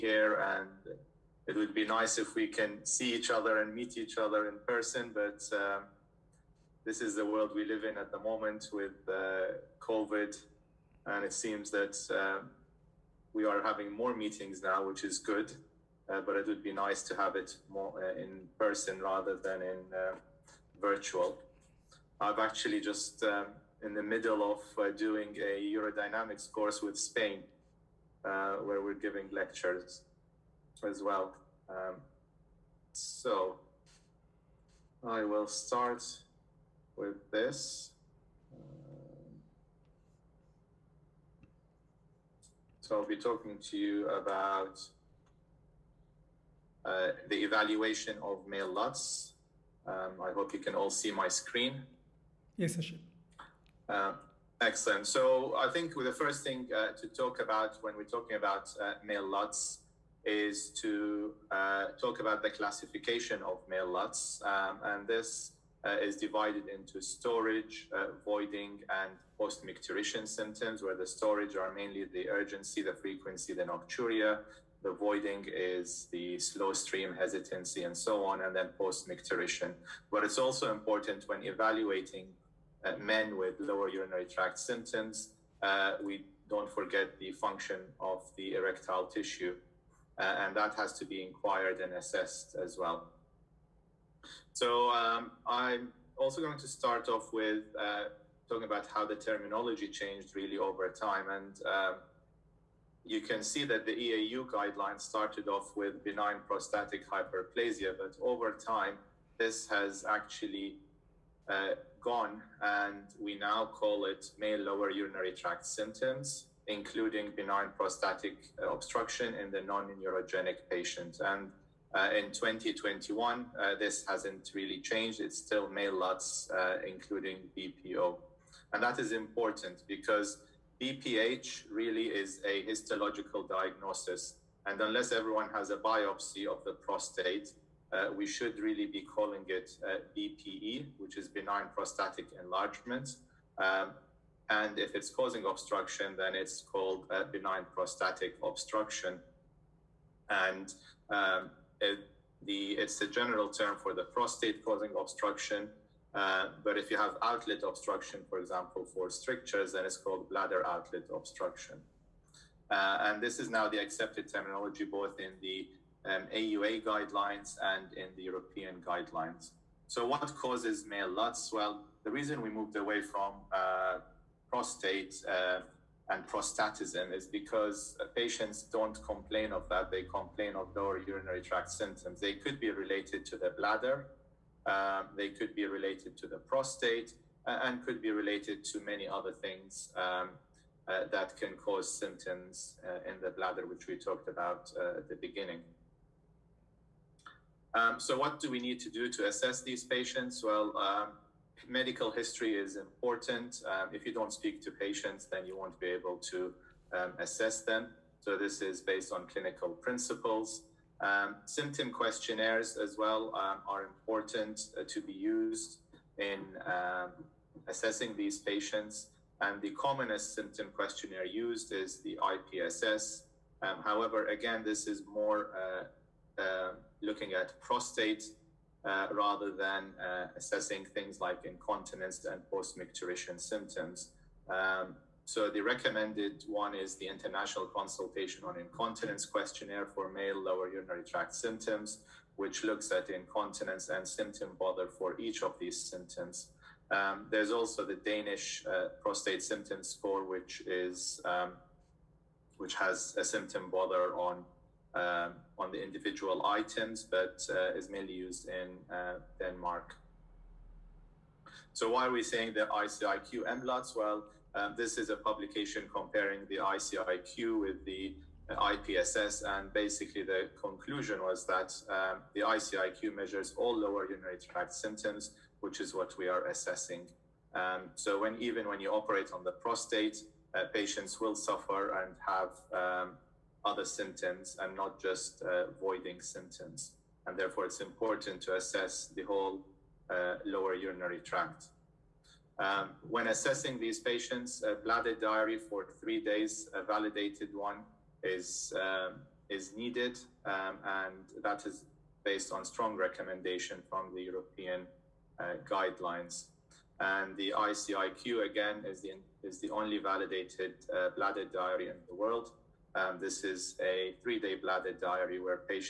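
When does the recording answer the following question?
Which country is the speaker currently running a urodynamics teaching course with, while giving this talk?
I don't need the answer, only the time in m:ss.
0:26.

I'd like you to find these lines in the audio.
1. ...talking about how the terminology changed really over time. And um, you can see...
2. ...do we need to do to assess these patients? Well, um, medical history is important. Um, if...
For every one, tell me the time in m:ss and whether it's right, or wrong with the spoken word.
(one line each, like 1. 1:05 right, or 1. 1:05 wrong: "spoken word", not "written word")
1. 1:38 right
2. 3:18 right.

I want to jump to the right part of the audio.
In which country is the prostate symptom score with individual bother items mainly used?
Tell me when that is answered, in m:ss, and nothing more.
4:19.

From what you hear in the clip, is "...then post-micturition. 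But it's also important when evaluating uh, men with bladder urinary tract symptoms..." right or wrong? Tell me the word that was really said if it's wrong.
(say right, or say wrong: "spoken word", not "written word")
wrong: "lower", not "bladder".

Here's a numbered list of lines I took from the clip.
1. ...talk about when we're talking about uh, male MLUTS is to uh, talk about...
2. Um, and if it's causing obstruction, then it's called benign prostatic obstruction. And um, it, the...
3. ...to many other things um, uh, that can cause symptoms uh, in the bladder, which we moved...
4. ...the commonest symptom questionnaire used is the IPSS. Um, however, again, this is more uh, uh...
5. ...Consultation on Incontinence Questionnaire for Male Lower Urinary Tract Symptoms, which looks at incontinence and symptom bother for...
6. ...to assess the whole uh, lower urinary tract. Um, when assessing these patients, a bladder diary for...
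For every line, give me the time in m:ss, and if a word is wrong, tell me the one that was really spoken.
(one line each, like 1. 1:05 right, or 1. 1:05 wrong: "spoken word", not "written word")
1. 0:57 wrong: "LUTS", not "MLUTS"
2. 2:23 right
3. 3:08 wrong: "talked", not "moved"
4. 3:39 right
5. 3:57 right
6. 4:48 right.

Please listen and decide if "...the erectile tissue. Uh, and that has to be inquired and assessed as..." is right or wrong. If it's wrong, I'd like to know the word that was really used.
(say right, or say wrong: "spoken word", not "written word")
right.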